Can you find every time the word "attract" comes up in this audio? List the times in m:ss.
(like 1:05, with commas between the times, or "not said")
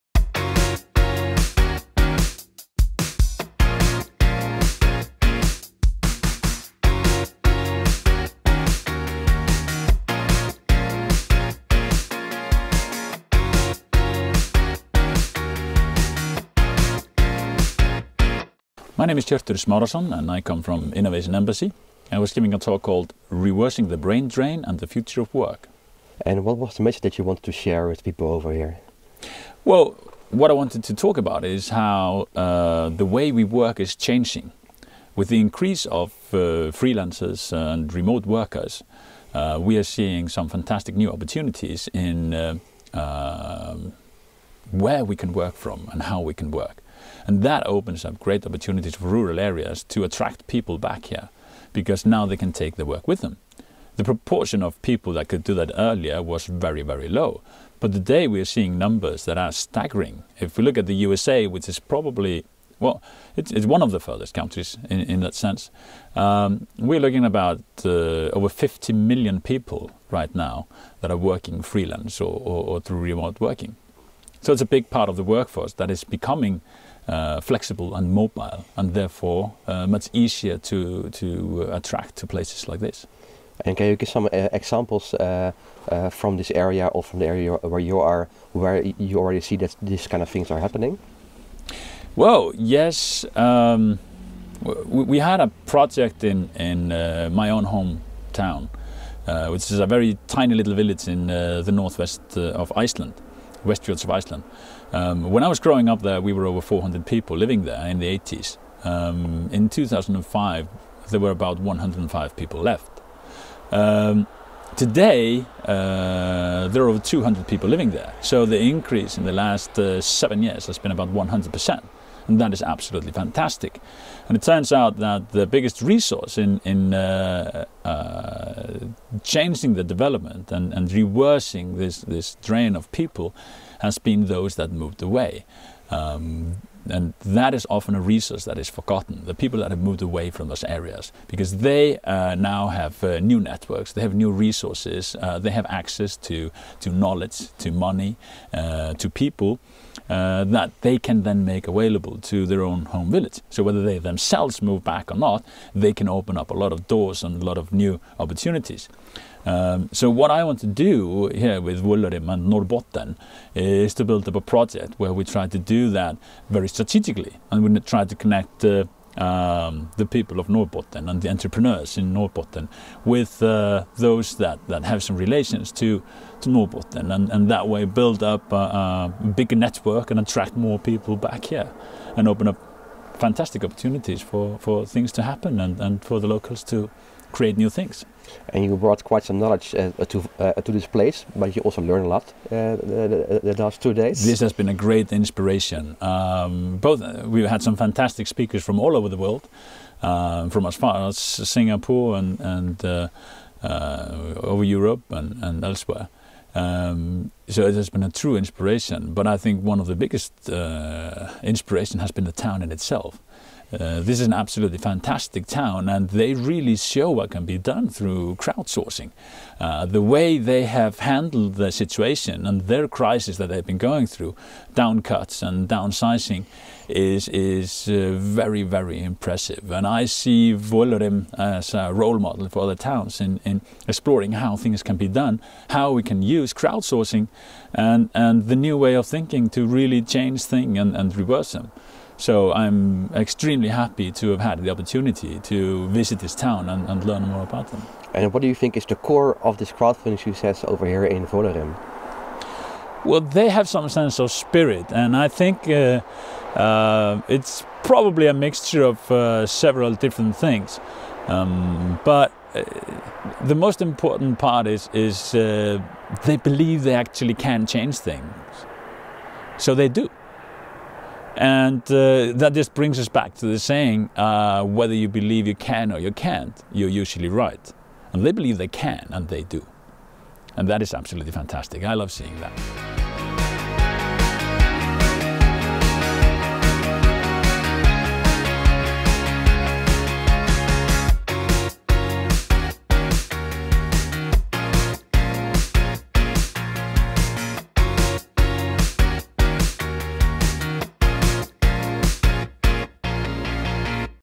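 0:50, 1:21, 3:00.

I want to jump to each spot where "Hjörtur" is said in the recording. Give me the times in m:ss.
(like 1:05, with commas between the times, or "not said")
0:19.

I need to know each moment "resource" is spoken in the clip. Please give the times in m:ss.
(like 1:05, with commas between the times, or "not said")
2:05, 2:18, 2:24.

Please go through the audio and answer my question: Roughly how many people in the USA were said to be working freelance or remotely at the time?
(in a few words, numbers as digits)
over 50 million.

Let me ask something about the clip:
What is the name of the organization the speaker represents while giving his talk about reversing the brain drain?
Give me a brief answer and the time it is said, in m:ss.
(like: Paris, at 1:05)
Innovation Embassy, at 0:20.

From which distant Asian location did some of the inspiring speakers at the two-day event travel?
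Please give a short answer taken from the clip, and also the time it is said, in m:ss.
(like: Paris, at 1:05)
Singapore, at 3:21.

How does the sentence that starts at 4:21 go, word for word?
Um, but uh, the most important part is, is uh, they believe they actually can change things.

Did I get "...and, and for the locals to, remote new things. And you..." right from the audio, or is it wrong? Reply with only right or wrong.
wrong.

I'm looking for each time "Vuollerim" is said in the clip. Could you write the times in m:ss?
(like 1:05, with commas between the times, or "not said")
2:41, 3:50, 4:11.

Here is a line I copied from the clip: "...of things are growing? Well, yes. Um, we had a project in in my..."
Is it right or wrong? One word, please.
wrong.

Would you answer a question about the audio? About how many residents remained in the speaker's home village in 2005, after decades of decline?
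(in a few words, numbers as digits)
105.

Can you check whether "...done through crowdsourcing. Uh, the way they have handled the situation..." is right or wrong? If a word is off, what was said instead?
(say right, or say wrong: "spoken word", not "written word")
right.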